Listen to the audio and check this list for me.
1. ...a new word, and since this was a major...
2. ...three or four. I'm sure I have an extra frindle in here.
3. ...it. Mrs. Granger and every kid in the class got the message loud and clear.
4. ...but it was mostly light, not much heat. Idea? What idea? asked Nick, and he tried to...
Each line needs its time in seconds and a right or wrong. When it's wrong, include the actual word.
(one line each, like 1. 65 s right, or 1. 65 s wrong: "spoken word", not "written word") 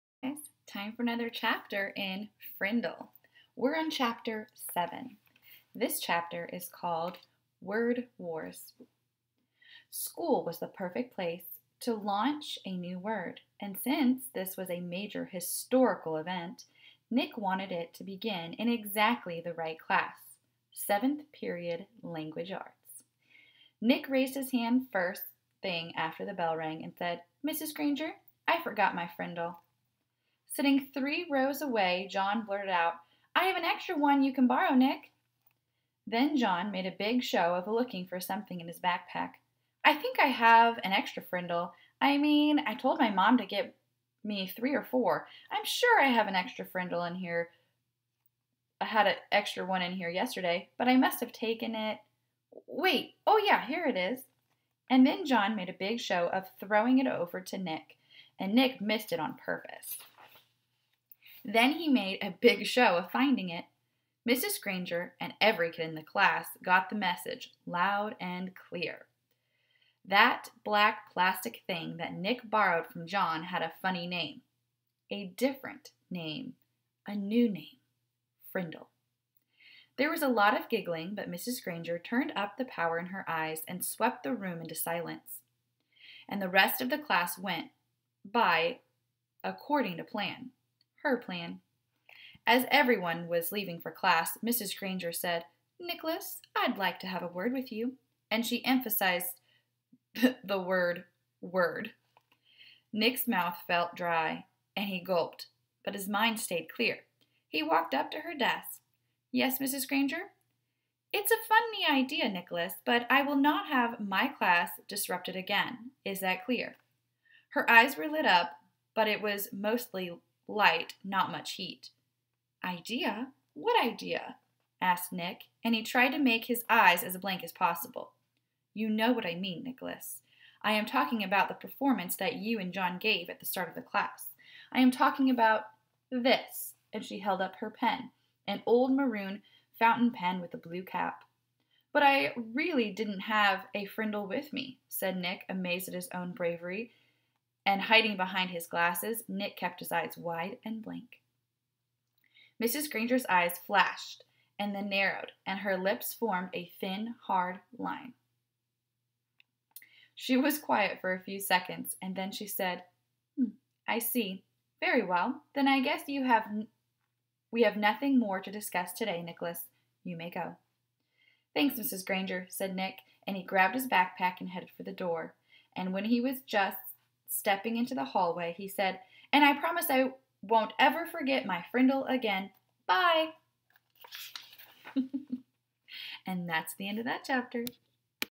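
1. 12 s right
2. 44 s right
3. 63 s right
4. 118 s right.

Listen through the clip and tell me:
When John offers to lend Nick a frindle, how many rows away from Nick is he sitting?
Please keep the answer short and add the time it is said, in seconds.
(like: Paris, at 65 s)
3, at 30 s.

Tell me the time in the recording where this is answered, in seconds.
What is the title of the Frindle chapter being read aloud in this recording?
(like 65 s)
7 s.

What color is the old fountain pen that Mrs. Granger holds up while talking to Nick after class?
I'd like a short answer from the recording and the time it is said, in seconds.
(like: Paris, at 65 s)
Maroon, at 138 s.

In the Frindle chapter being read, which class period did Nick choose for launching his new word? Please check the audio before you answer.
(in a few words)
7th period.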